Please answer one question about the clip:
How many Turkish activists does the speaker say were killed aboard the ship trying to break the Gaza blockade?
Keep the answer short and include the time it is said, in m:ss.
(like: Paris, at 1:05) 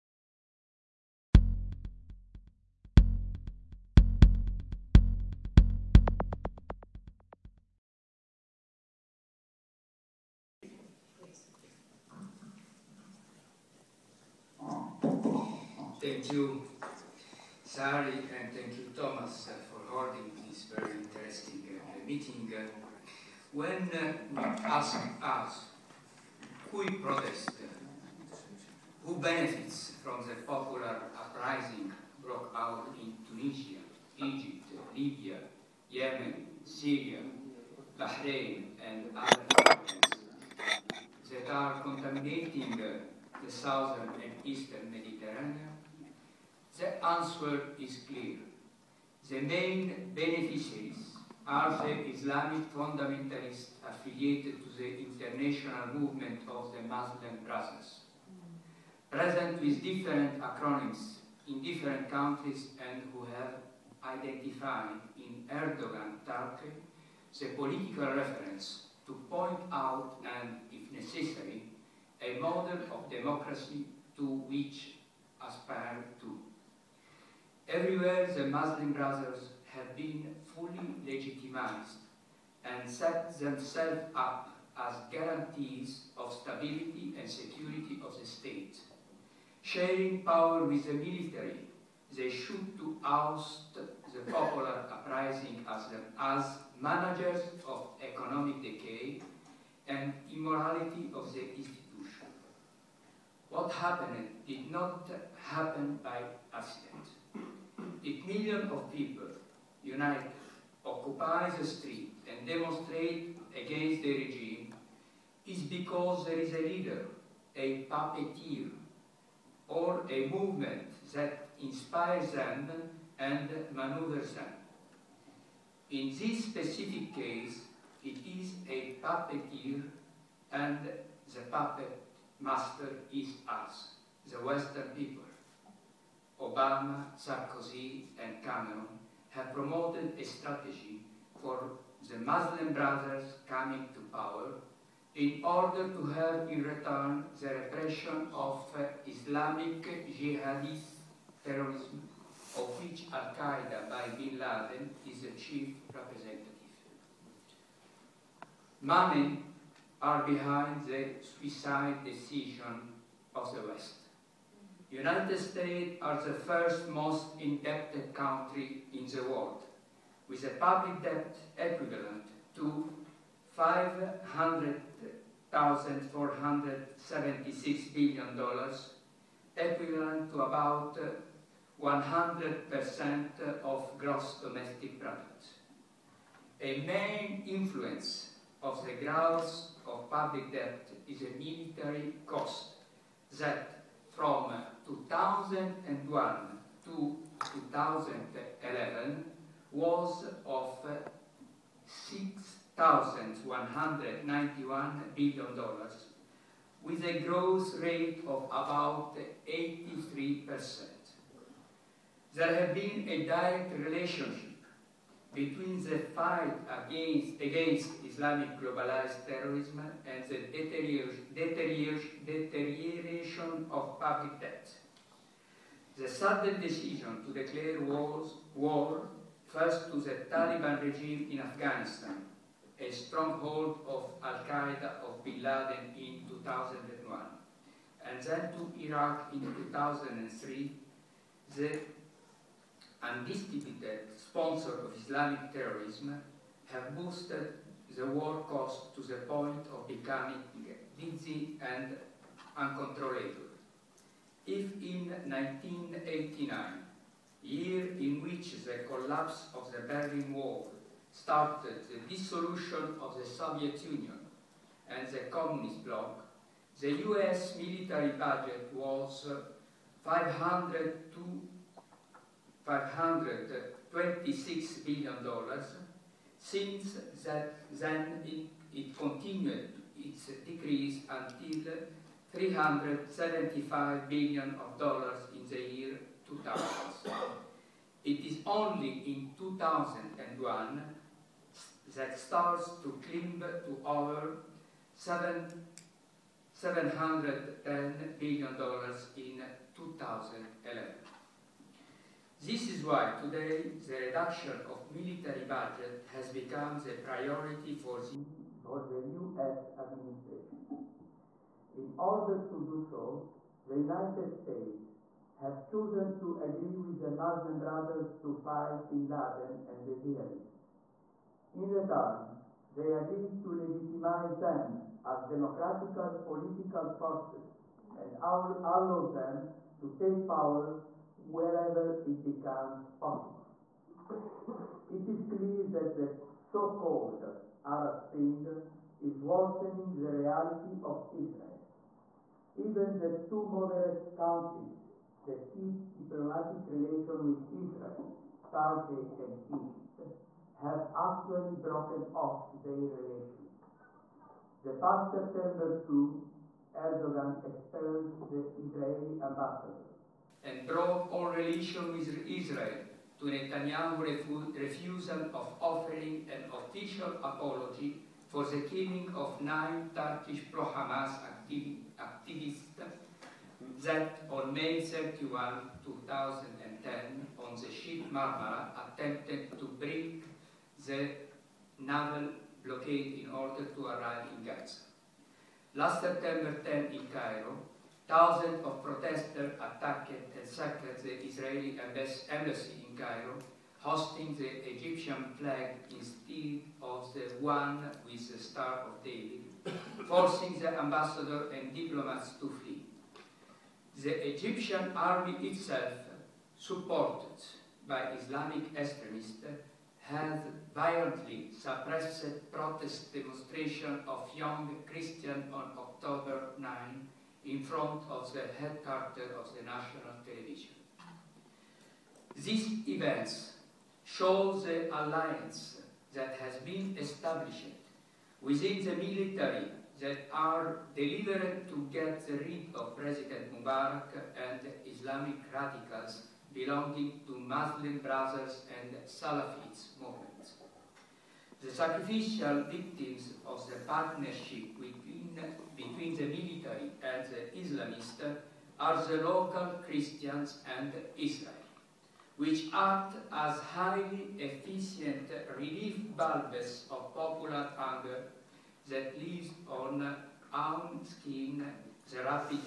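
9, at 6:09.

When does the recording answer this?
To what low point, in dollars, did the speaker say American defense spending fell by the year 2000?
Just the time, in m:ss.
4:42.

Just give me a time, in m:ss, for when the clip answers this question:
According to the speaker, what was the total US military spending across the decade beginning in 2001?
3:22.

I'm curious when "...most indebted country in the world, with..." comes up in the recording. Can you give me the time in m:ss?
2:46.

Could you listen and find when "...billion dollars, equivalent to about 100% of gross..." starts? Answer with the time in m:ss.
2:57.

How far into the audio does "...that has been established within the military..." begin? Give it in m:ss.
7:06.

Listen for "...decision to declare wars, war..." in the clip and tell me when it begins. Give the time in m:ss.
3:46.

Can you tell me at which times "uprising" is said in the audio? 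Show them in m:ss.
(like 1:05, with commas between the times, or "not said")
0:31, 1:34.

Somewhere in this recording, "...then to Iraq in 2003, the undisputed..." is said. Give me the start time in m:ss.
3:58.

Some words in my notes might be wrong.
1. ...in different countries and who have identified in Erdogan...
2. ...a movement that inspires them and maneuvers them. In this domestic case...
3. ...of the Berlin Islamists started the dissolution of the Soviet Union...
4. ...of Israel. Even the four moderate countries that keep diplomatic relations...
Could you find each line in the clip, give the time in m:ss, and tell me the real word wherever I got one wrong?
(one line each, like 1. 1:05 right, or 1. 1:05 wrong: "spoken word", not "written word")
1. 1:01 right
2. 2:00 wrong: "specific", not "domestic"
3. 4:19 wrong: "Wall", not "Islamists"
4. 5:40 wrong: "two", not "four".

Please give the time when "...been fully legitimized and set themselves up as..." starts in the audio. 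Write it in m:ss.
1:19.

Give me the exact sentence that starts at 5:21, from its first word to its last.
In return, they agreed to legitimize them as democratic political forces and allow them to take power wherever it becomes possible.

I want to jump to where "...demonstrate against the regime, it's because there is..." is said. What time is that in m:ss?
1:52.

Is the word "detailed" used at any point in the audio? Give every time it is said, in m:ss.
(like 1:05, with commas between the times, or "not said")
not said.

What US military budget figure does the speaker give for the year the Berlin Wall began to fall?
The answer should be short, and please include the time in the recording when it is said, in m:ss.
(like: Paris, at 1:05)
$526 billion, at 4:30.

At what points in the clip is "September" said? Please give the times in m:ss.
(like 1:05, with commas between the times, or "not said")
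5:55, 6:26.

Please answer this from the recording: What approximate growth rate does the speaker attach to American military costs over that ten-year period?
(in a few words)
83%.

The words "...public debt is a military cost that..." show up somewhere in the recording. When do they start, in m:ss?
3:10.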